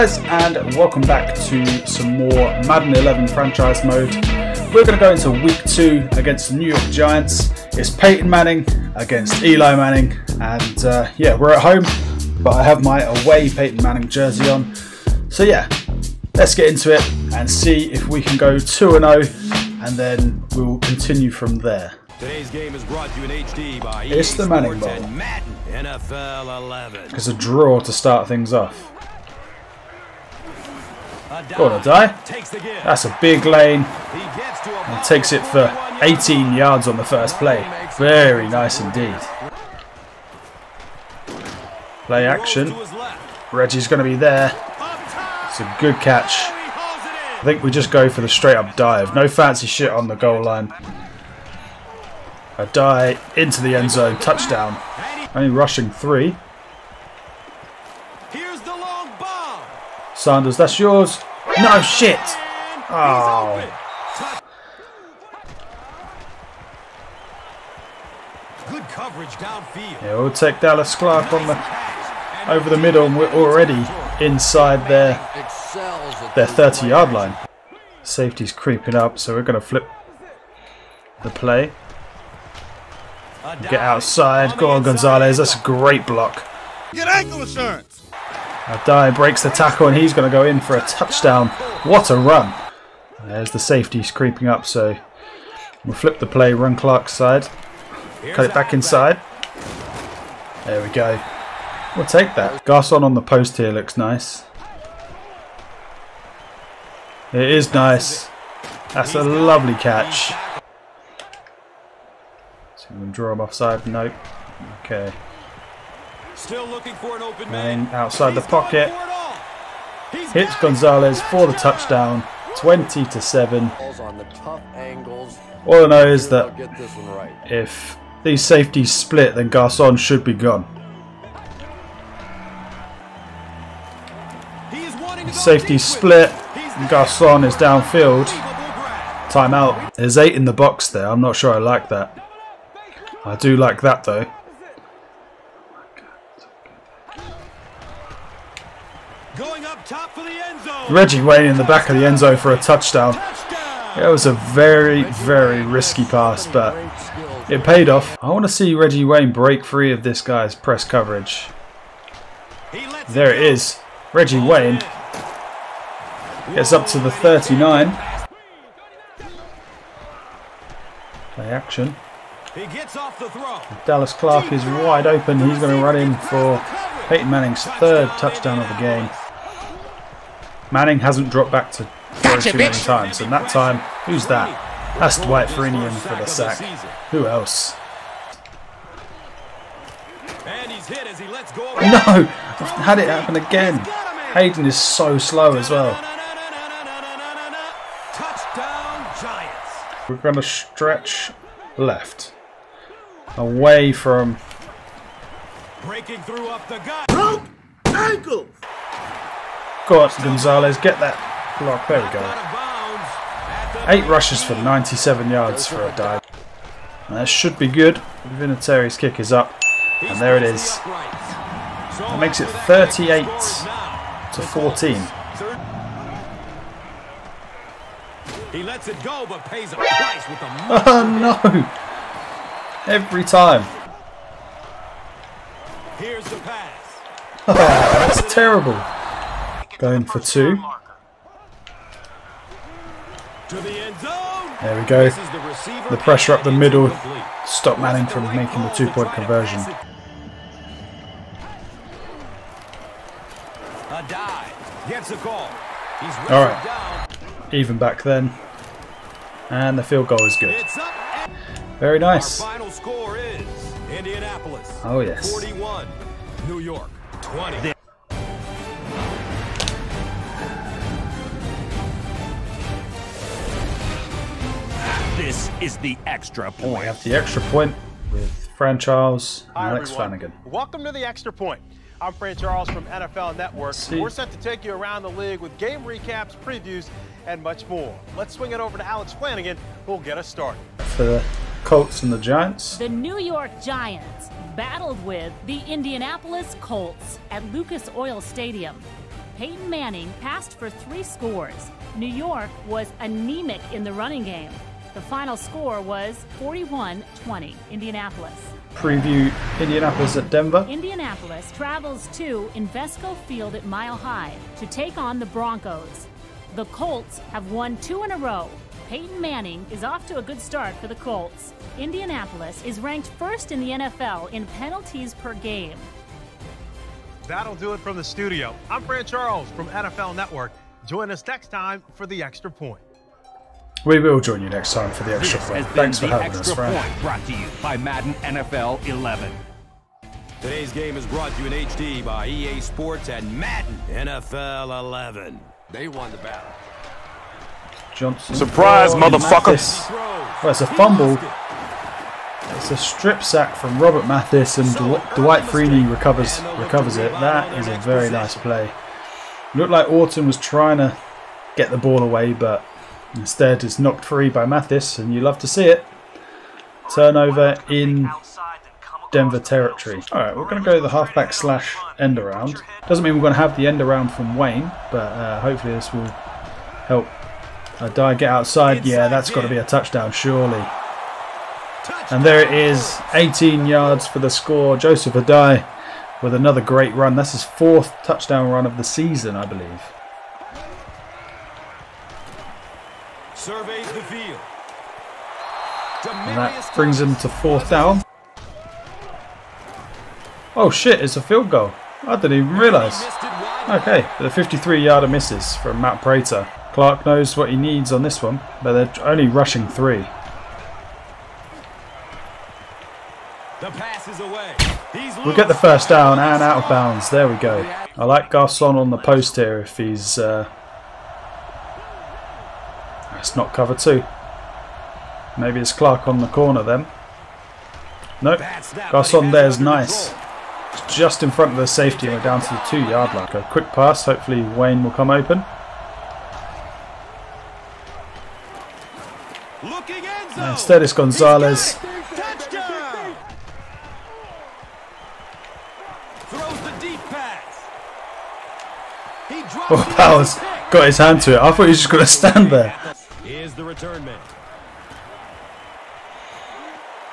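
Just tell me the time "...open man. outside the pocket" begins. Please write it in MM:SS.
01:57.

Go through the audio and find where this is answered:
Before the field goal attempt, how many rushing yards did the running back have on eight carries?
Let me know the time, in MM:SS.
03:34.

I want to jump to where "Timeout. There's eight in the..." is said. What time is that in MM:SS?
02:19.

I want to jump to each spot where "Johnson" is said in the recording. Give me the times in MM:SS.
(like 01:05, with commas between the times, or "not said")
05:47.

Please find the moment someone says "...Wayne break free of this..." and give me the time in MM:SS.
02:39.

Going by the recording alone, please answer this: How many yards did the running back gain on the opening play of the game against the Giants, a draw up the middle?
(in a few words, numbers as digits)
18.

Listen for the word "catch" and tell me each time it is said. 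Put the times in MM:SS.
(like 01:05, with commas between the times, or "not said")
00:45, 01:49.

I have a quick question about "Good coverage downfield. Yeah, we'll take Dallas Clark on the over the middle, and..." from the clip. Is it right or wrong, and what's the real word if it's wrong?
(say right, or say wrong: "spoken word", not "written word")
right.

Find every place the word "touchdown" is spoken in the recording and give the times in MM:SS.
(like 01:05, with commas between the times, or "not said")
00:54, 01:30, 02:01, 02:32, 02:58, 06:19, 06:28.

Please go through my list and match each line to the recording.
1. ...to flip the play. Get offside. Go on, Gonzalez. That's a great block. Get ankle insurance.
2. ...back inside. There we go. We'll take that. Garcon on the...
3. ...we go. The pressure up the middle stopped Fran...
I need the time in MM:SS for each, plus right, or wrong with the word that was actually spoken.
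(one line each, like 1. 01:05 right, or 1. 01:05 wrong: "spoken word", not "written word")
1. 01:19 wrong: "outside", not "offside"
2. 01:38 right
3. 04:04 wrong: "Manning", not "Fran".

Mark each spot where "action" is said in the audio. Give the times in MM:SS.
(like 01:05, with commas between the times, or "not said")
00:42, 02:51.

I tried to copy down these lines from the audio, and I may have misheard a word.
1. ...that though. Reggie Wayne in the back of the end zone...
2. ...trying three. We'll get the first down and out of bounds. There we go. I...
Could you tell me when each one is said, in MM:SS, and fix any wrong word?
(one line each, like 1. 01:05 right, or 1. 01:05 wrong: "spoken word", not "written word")
1. 02:23 right
2. 06:49 wrong: "rushing", not "trying".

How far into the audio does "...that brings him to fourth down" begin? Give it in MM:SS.
06:36.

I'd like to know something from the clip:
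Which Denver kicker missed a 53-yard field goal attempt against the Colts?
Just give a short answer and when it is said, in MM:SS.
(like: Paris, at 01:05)
Matt Prater, at 06:45.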